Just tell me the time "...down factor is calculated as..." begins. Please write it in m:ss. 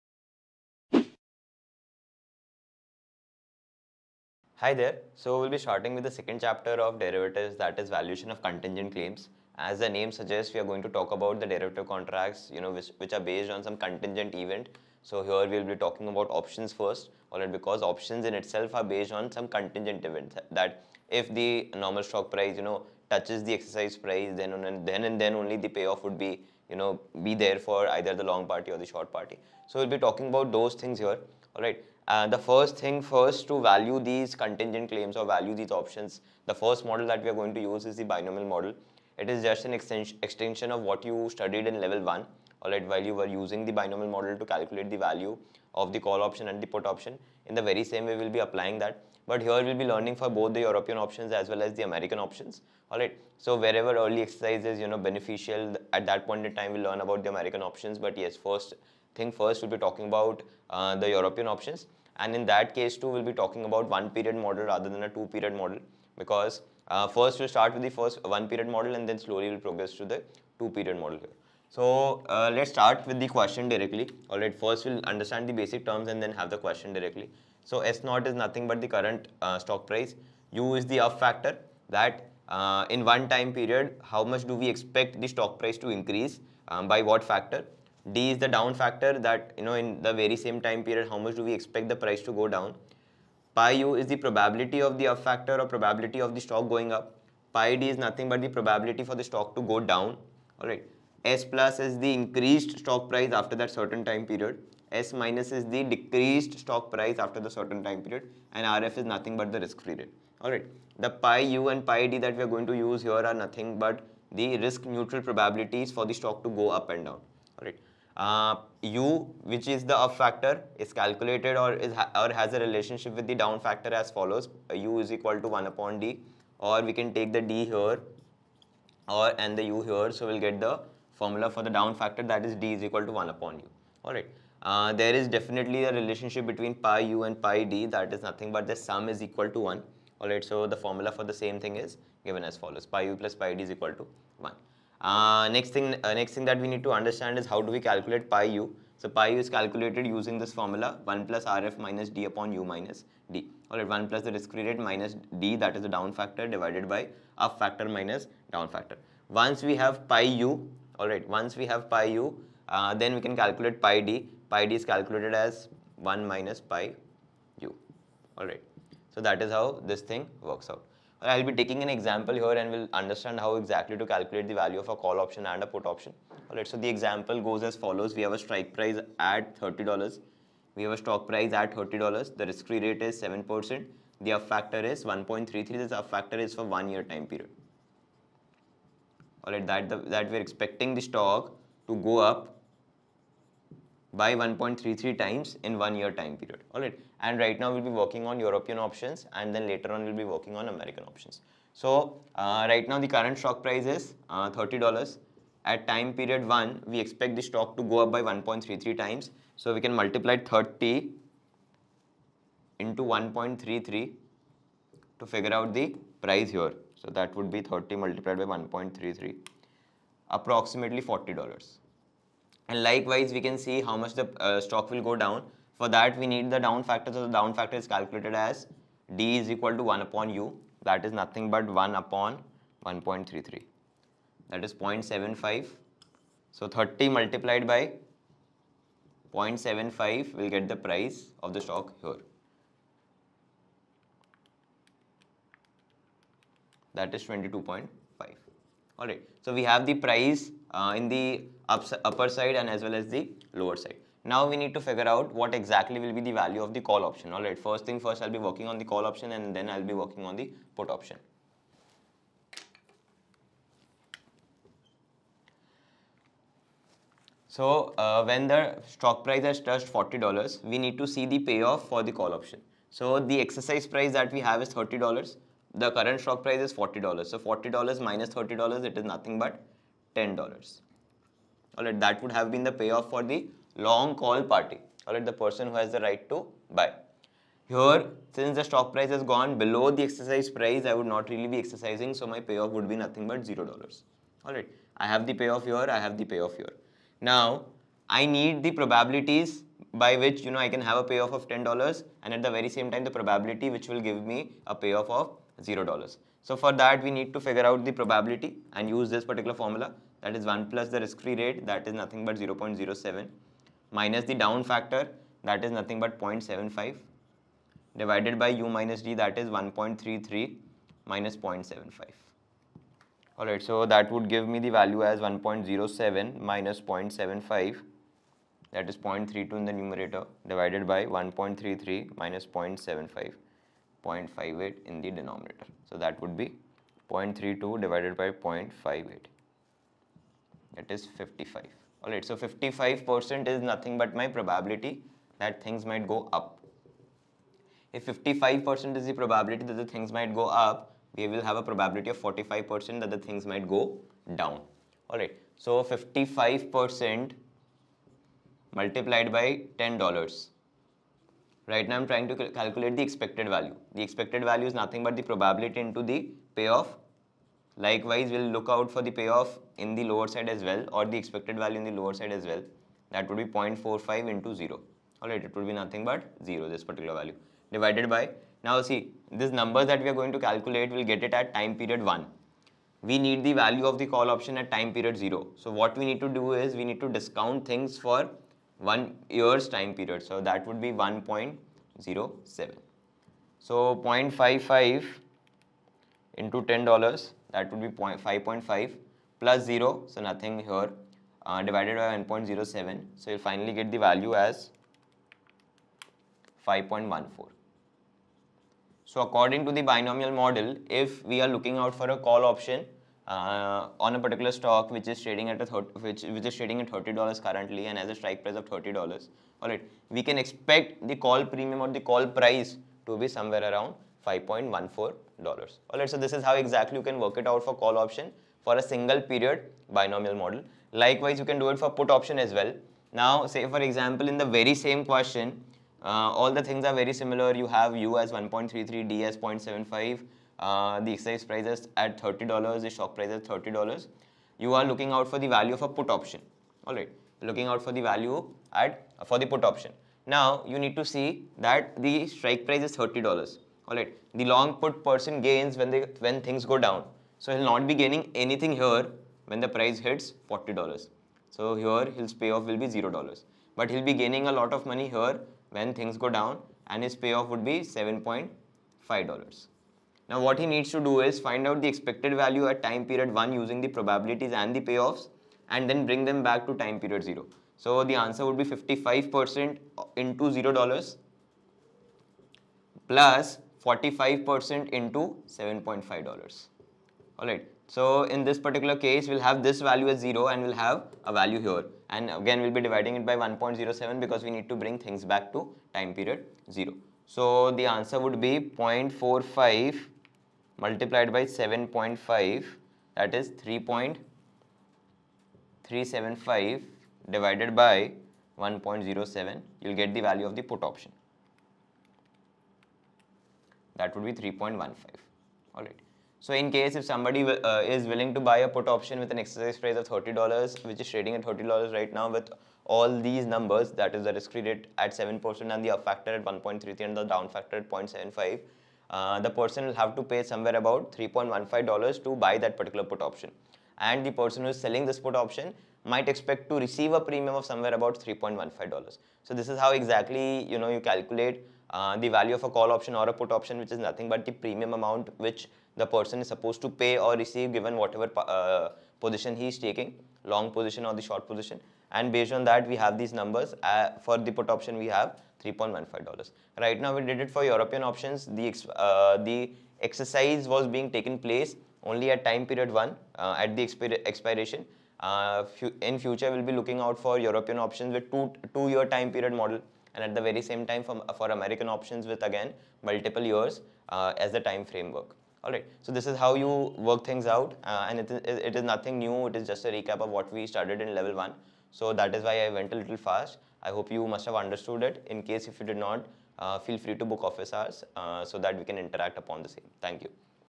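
3:47.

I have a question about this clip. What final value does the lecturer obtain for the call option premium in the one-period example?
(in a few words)
$5.14.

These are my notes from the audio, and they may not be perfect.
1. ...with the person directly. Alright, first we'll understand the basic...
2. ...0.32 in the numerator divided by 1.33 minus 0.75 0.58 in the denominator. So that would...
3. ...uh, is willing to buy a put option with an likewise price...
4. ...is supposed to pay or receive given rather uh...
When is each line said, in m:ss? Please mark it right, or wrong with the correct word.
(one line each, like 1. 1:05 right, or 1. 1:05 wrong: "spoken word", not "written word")
1. 1:13 wrong: "question", not "person"
2. 5:28 right
3. 8:37 wrong: "exercise", not "likewise"
4. 9:06 wrong: "whatever", not "rather".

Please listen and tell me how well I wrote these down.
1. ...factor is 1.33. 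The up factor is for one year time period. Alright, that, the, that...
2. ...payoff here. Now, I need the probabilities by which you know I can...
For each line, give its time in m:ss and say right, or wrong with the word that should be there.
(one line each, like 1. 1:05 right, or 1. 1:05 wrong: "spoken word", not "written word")
1. 3:04 right
2. 4:56 right.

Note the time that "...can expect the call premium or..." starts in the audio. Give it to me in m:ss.
7:00.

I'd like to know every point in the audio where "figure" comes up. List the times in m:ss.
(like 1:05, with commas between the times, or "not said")
3:35, 4:14, 5:07.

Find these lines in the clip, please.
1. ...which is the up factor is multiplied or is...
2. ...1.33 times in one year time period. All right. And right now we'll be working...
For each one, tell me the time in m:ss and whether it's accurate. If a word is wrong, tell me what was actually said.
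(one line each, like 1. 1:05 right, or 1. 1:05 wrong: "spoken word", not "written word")
1. 1:59 wrong: "calculated", not "multiplied"
2. 3:14 right.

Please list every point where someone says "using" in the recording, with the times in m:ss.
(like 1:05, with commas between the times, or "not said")
0:43, 2:30, 7:53.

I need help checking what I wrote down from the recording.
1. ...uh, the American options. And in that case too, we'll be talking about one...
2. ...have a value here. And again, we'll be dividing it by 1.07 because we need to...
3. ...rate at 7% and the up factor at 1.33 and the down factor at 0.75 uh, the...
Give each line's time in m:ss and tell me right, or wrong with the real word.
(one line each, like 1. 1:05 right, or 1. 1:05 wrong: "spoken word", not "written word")
1. 1:00 wrong: "European", not "American"
2. 8:10 right
3. 8:44 right.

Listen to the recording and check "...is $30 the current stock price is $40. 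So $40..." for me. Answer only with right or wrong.
right.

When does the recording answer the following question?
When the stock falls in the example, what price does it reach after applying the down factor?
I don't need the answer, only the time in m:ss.
4:07.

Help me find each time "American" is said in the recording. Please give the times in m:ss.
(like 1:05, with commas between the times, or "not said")
0:51, 0:57, 3:20, 9:31.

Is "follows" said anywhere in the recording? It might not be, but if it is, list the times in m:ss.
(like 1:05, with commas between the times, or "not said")
2:04, 2:22, 2:57.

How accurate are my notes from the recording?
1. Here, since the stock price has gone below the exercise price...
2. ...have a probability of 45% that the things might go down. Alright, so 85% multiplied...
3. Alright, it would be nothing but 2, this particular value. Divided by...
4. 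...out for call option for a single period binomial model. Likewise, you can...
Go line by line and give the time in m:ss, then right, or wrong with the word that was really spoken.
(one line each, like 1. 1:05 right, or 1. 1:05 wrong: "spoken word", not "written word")
1. 4:47 right
2. 5:51 wrong: "55", not "85"
3. 6:15 wrong: "0", not "2"
4. 7:07 right.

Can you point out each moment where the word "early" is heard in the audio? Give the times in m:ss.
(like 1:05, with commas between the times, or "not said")
0:53.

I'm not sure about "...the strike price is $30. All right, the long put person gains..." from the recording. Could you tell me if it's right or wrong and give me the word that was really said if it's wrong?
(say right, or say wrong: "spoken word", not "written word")
right.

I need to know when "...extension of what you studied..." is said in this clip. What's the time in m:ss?
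0:40.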